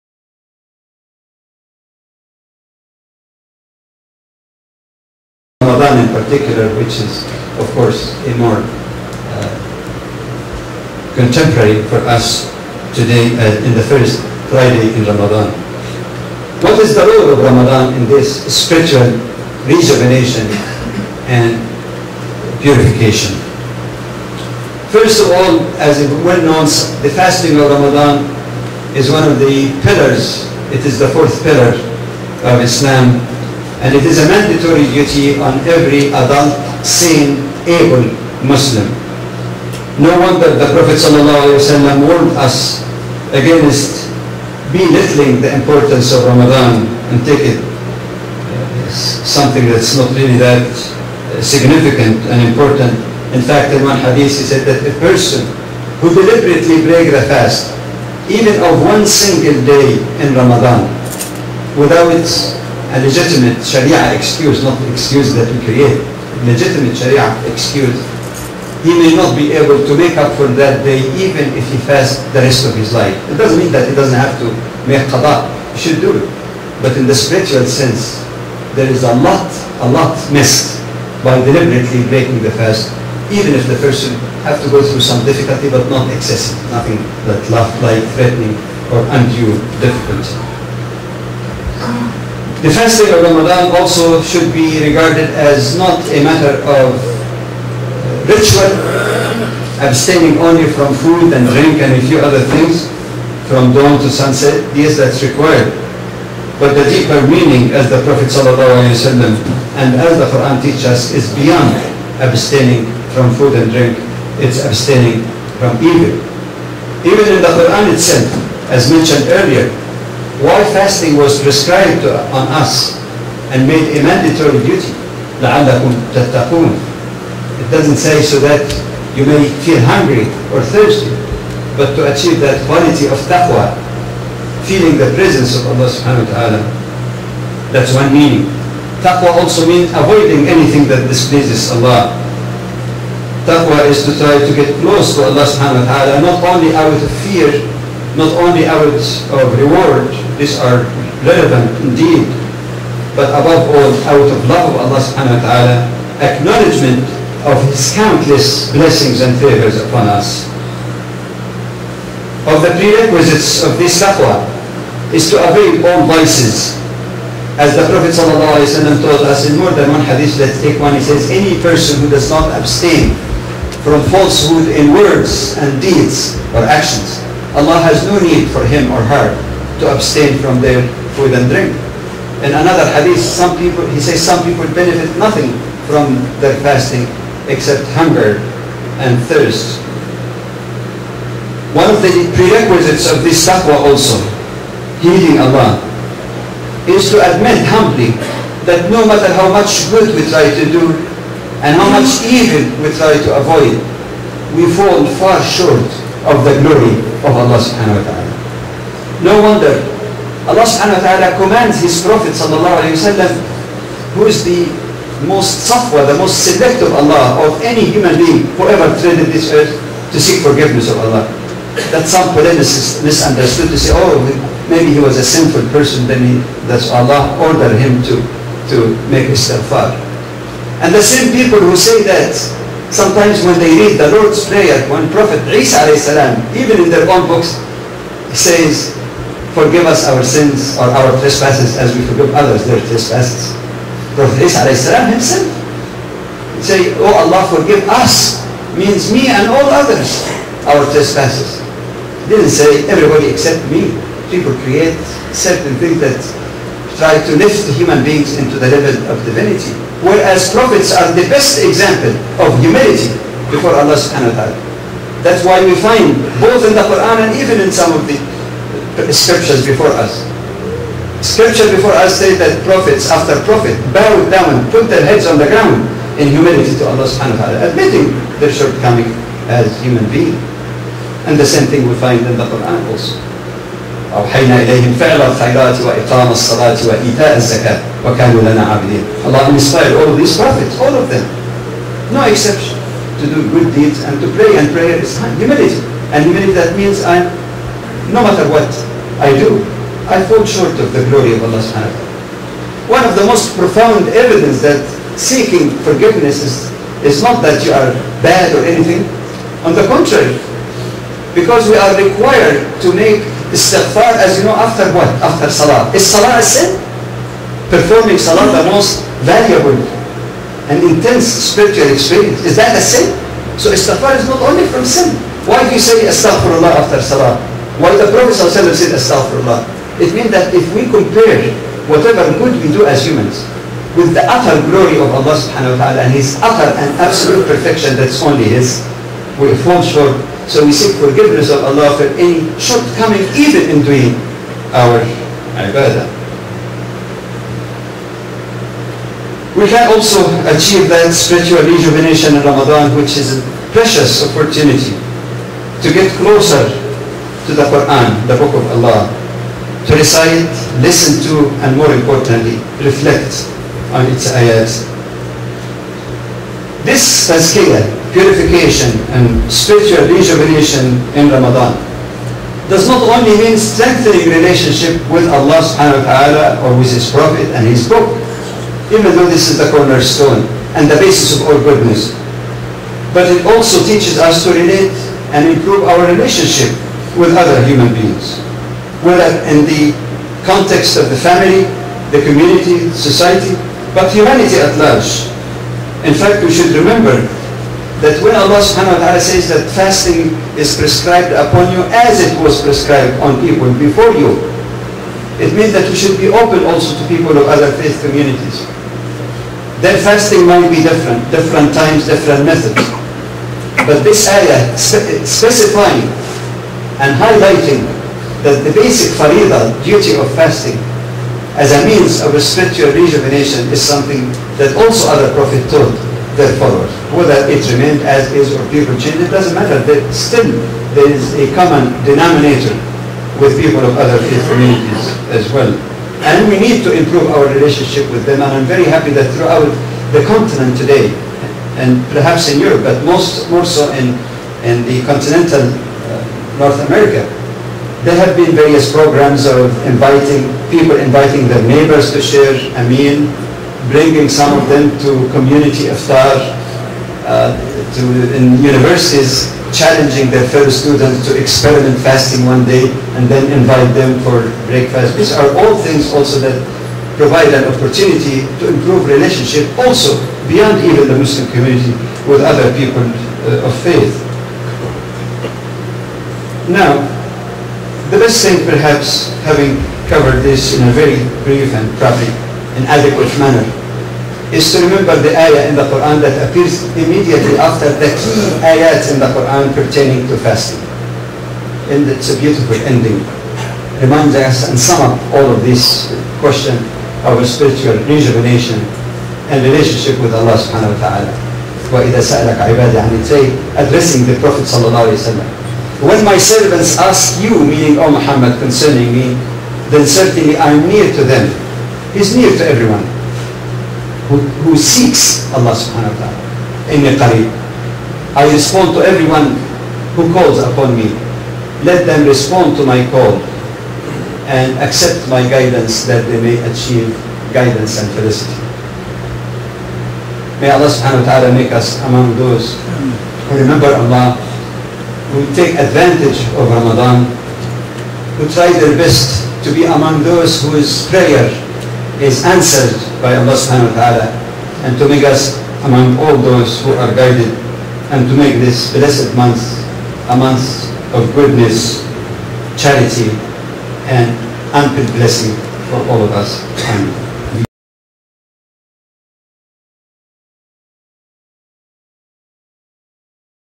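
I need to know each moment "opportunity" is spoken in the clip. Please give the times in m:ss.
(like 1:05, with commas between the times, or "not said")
5:54, 7:47.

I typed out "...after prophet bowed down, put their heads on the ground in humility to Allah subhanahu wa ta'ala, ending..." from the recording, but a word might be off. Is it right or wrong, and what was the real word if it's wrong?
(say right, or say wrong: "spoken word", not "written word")
wrong: "admitting", not "ending".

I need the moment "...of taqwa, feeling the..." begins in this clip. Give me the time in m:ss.
2:13.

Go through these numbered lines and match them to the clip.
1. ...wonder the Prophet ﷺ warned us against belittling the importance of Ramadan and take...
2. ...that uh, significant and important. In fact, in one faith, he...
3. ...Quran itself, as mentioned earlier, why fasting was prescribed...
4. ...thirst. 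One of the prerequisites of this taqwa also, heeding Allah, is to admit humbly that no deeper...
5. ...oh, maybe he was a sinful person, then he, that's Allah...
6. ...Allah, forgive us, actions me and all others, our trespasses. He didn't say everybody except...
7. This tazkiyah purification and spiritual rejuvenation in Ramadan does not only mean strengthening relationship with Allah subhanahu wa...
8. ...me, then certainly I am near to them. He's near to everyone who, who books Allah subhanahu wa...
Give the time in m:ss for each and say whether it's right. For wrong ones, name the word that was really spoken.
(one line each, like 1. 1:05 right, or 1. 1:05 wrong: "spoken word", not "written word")
1. 0:40 right
2. 0:50 wrong: "hadith", not "faith"
3. 1:57 right
4. 3:09 wrong: "matter", not "deeper"
5. 3:43 right
6. 4:07 wrong: "means", not "actions"
7. 6:06 right
8. 8:29 wrong: "seeks", not "books".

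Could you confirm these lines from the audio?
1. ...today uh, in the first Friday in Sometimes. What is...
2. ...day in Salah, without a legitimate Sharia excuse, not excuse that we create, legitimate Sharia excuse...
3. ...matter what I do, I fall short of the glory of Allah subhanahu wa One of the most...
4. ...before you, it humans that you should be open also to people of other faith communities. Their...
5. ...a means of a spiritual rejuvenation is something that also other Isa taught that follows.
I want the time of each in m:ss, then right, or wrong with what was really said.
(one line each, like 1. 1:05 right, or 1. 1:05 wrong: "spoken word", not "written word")
1. 0:12 wrong: "Ramadan", not "Sometimes"
2. 0:59 wrong: "Ramadan", not "Salah"
3. 4:58 right
4. 6:43 wrong: "means", not "humans"
5. 7:01 wrong: "Prophet", not "Isa".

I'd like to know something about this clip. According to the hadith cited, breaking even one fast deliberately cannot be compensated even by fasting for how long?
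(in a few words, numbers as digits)
the rest of his life.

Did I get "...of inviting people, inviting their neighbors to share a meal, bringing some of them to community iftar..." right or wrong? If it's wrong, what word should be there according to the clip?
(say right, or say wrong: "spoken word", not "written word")
right.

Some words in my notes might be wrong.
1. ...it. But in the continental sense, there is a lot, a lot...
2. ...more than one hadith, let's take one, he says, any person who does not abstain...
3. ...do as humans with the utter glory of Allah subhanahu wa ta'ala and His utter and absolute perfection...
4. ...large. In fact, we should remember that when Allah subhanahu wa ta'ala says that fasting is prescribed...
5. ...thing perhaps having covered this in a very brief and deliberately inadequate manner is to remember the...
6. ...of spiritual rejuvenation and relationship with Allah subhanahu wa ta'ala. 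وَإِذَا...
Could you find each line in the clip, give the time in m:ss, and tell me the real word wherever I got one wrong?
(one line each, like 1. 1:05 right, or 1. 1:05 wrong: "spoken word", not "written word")
1. 1:16 wrong: "spiritual", not "continental"
2. 2:49 right
3. 5:32 right
4. 6:34 right
5. 7:58 wrong: "probably", not "deliberately"
6. 8:17 right.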